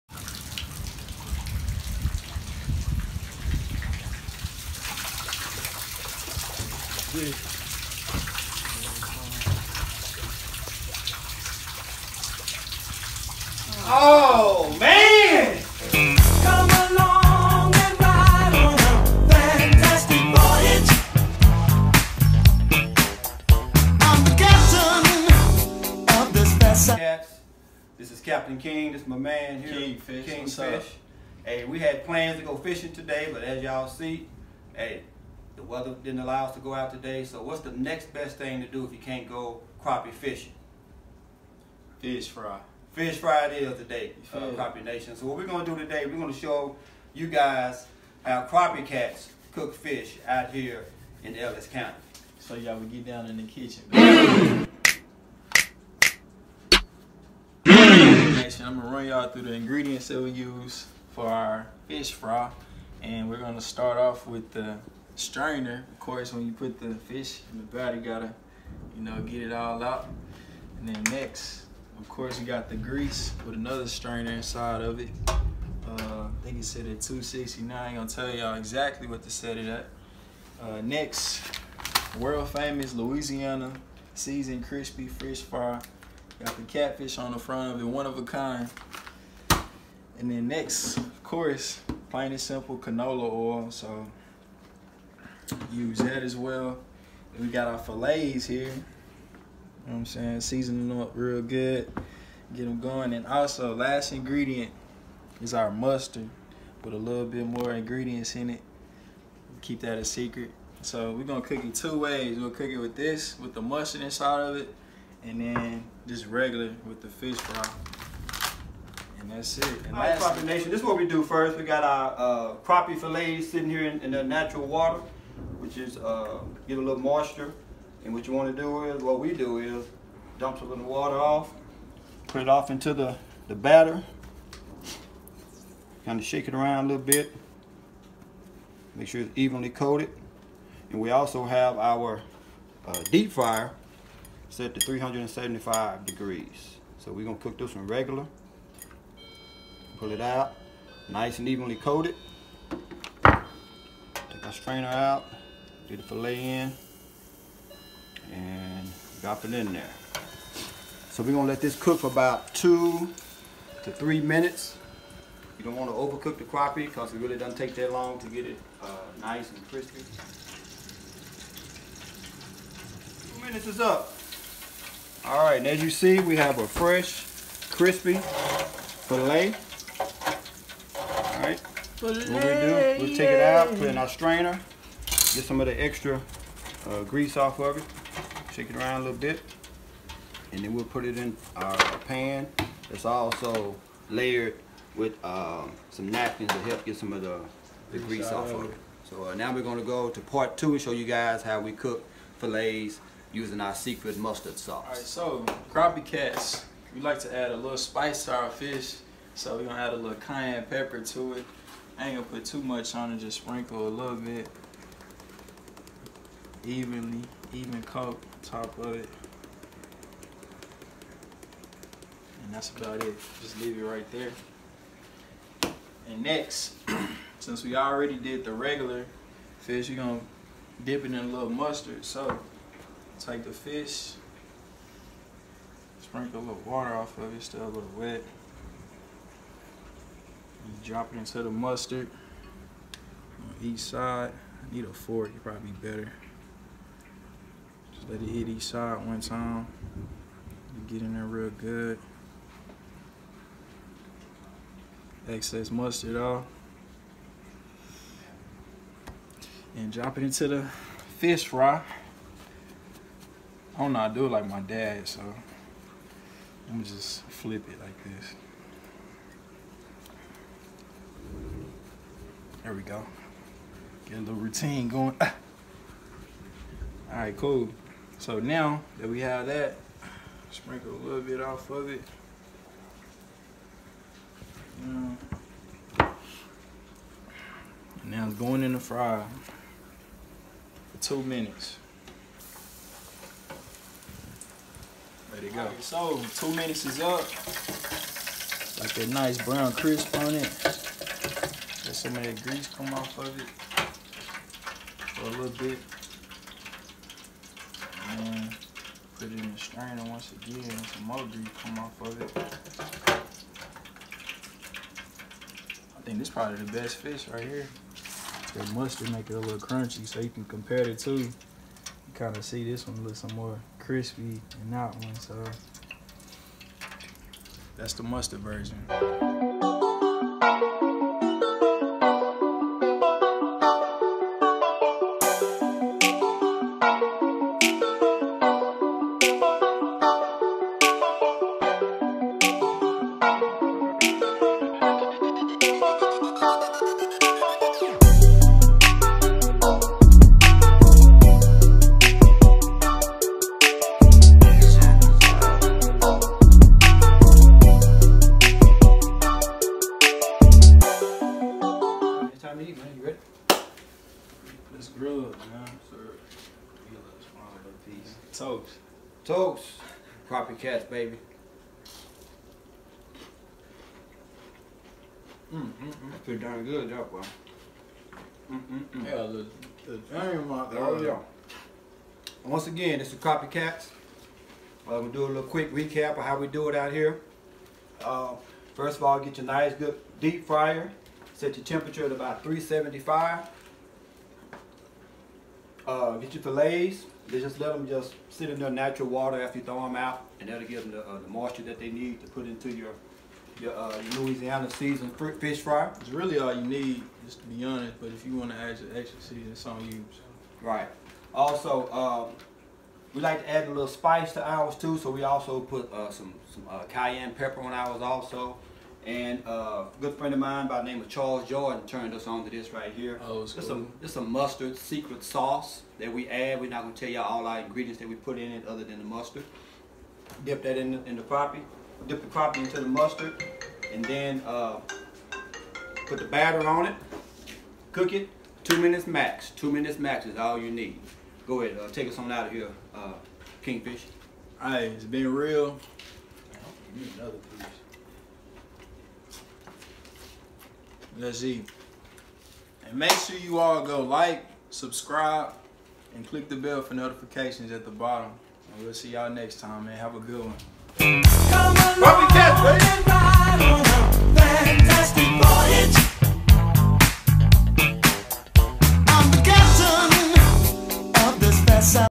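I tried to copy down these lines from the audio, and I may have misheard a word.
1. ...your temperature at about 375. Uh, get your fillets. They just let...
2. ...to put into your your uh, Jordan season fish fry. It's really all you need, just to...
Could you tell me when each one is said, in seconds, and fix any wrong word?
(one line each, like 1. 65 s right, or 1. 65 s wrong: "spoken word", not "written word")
1. 391 s right
2. 402 s wrong: "Louisiana", not "Jordan".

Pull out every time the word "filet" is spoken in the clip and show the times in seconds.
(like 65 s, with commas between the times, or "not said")
179 s.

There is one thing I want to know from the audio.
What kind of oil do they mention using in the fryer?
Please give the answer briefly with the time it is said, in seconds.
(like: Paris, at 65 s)
canola oil, at 92 s.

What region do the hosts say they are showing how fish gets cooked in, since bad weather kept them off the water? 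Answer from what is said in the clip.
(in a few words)
Ellis County.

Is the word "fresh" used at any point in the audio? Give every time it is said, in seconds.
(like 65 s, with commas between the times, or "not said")
176 s.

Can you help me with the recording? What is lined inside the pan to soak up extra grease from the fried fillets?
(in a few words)
napkins.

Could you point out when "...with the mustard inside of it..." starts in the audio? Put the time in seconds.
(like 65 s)
113 s.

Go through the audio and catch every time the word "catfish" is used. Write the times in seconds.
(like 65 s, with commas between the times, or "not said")
86 s.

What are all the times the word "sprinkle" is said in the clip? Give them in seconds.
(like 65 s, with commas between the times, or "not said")
213 s, 236 s, 280 s.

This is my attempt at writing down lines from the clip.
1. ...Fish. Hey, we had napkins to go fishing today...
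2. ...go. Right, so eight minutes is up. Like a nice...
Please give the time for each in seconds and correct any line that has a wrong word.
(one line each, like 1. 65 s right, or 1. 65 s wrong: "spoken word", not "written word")
1. 30 s wrong: "plans", not "napkins"
2. 295 s wrong: "two", not "eight".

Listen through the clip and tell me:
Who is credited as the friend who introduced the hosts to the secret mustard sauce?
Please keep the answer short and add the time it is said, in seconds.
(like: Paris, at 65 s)
Charles Jordan, at 421 s.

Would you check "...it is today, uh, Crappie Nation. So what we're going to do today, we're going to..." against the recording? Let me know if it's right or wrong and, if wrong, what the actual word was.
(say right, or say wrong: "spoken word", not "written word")
right.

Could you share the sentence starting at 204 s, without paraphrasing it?
All right, so crappie cats, we like to add a little spice to our fish.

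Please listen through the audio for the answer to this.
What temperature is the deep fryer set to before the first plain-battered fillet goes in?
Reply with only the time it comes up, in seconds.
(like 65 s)
144 s.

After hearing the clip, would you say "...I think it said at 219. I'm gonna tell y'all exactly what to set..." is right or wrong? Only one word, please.
wrong.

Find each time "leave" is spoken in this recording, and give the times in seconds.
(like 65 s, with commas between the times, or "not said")
223 s.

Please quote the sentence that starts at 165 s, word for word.
You don't wanna overcook the crappie because it really doesn't take that long to get it uh, nice and crispy.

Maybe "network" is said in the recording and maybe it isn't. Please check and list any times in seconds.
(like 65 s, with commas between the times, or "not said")
not said.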